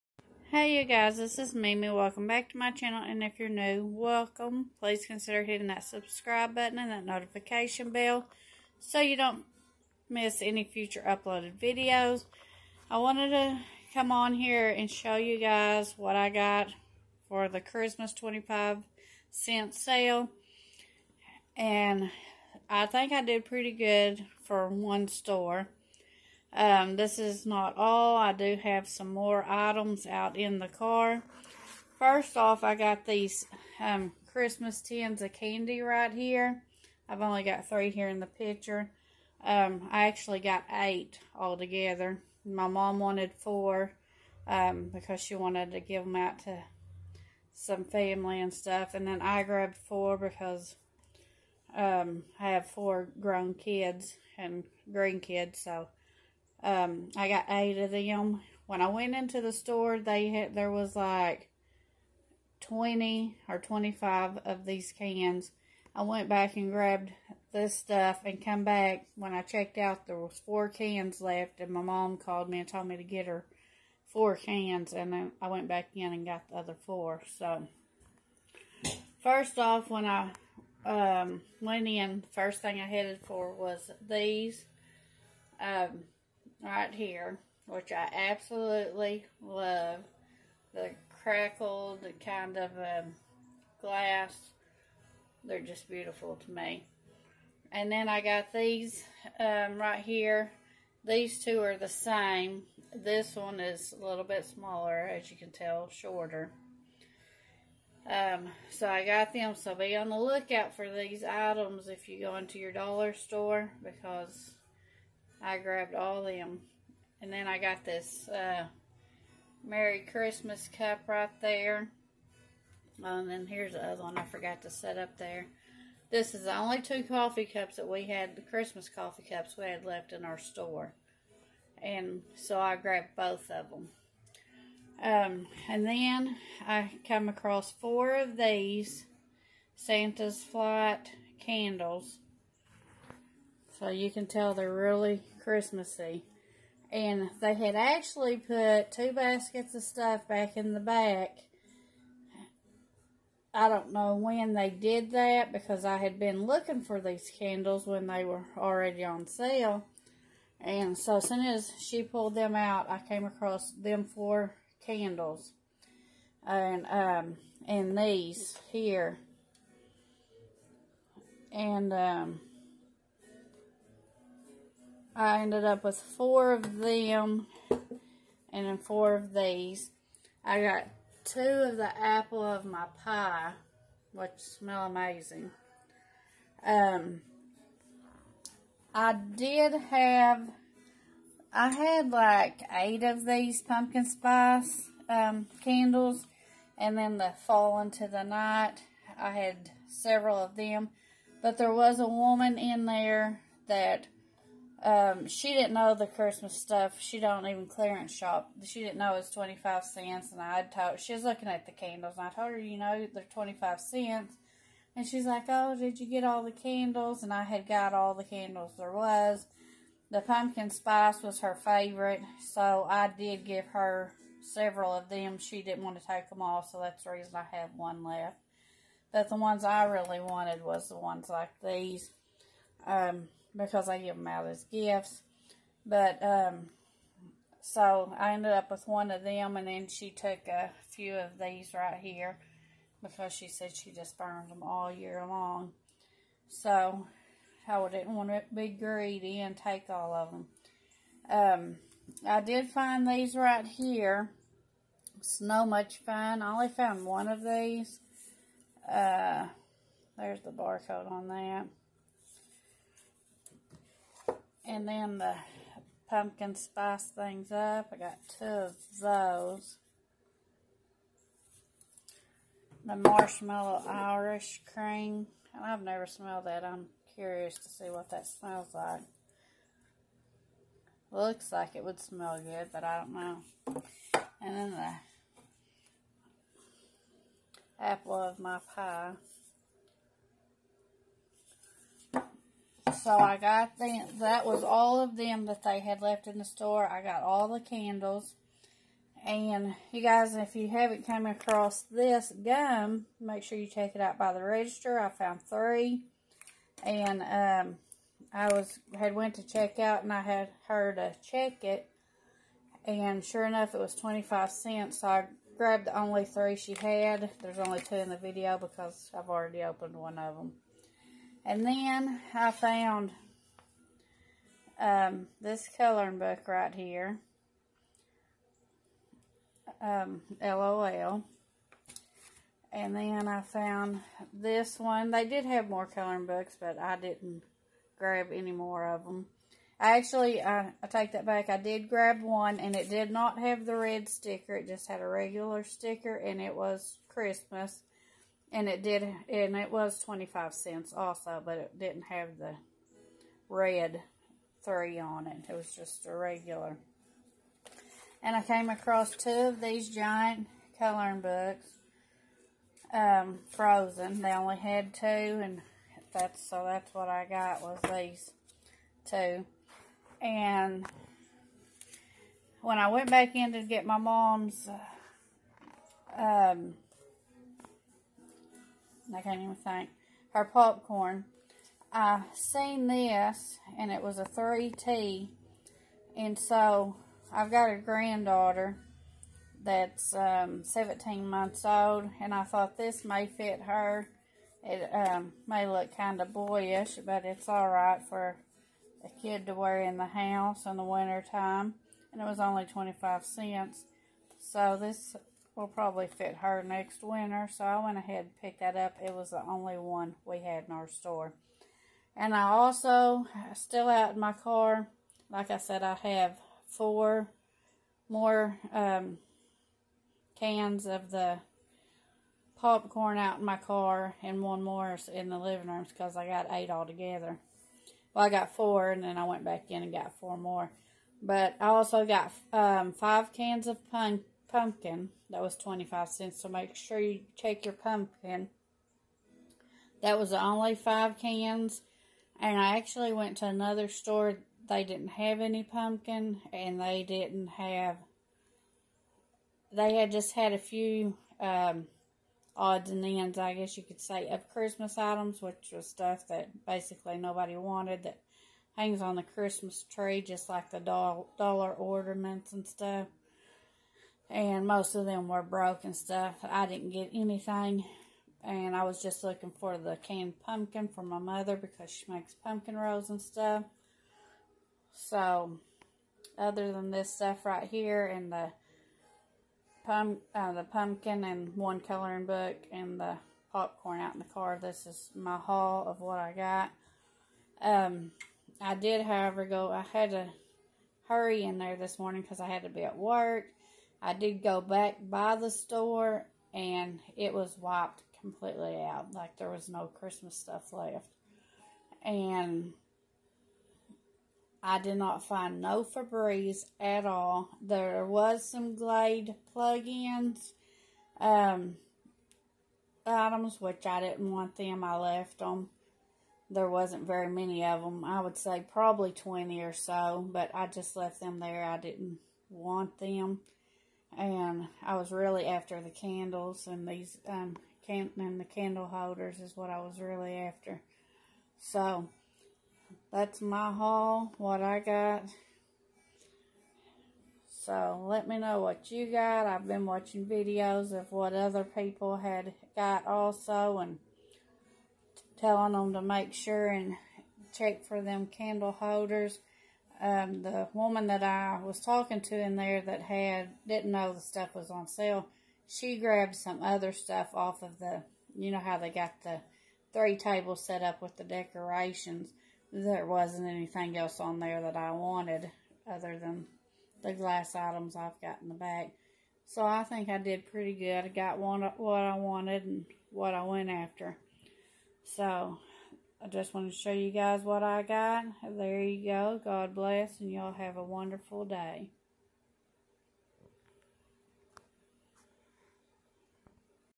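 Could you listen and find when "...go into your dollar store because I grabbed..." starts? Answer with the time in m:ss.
1:52.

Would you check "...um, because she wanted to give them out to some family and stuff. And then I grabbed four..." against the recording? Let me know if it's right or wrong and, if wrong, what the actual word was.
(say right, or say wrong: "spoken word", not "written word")
right.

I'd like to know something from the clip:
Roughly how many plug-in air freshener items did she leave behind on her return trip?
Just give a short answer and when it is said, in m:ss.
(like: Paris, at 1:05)
20, at 8:38.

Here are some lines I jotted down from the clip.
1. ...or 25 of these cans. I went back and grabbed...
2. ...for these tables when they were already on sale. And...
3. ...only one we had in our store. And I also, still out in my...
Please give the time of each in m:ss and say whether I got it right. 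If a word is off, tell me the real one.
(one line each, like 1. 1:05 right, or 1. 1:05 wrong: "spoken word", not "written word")
1. 1:03 right
2. 2:36 wrong: "candles", not "tables"
3. 6:49 right.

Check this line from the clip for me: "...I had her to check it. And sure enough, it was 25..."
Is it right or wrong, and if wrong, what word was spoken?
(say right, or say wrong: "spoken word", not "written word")
right.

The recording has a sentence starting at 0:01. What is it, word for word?
Welcome back to my channel and if you're new, welcome.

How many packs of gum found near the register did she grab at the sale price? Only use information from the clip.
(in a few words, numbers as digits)
3.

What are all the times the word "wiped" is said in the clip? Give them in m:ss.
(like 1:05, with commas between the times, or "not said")
8:17.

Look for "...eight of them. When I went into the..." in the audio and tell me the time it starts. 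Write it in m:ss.
0:57.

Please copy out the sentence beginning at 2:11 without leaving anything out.
And so I grabbed both of them.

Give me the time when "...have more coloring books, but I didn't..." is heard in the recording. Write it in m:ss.
5:35.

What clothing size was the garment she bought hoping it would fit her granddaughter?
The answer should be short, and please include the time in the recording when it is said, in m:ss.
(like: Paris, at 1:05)
3T, at 6:24.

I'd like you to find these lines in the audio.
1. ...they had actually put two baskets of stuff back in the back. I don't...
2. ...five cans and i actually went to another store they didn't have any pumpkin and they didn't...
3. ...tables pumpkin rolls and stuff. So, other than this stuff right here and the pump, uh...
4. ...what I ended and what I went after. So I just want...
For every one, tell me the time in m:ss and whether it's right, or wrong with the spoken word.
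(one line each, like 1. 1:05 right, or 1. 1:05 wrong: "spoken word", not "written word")
1. 2:27 right
2. 7:20 right
3. 7:52 wrong: "makes", not "tables"
4. 9:31 wrong: "wanted", not "ended".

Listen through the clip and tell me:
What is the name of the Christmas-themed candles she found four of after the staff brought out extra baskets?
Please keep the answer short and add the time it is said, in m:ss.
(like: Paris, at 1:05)
Santa's Flight, at 2:19.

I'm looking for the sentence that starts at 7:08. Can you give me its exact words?
Well, I got four and then I went back in and got four more.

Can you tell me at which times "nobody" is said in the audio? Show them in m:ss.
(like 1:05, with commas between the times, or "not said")
7:37.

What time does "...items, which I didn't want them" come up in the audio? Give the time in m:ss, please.
8:33.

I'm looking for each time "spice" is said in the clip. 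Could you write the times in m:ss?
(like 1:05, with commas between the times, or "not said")
3:14, 3:40, 4:26.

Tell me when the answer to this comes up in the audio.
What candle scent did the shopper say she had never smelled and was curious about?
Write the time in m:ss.
4:32.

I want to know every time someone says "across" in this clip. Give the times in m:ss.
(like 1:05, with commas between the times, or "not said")
2:17, 2:43, 5:01, 5:58.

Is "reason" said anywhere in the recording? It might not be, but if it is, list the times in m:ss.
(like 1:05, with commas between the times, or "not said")
3:47.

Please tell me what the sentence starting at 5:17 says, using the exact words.
There's only two in the video because I've already opened one of them.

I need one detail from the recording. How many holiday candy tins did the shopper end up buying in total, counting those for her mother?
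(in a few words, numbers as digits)
8.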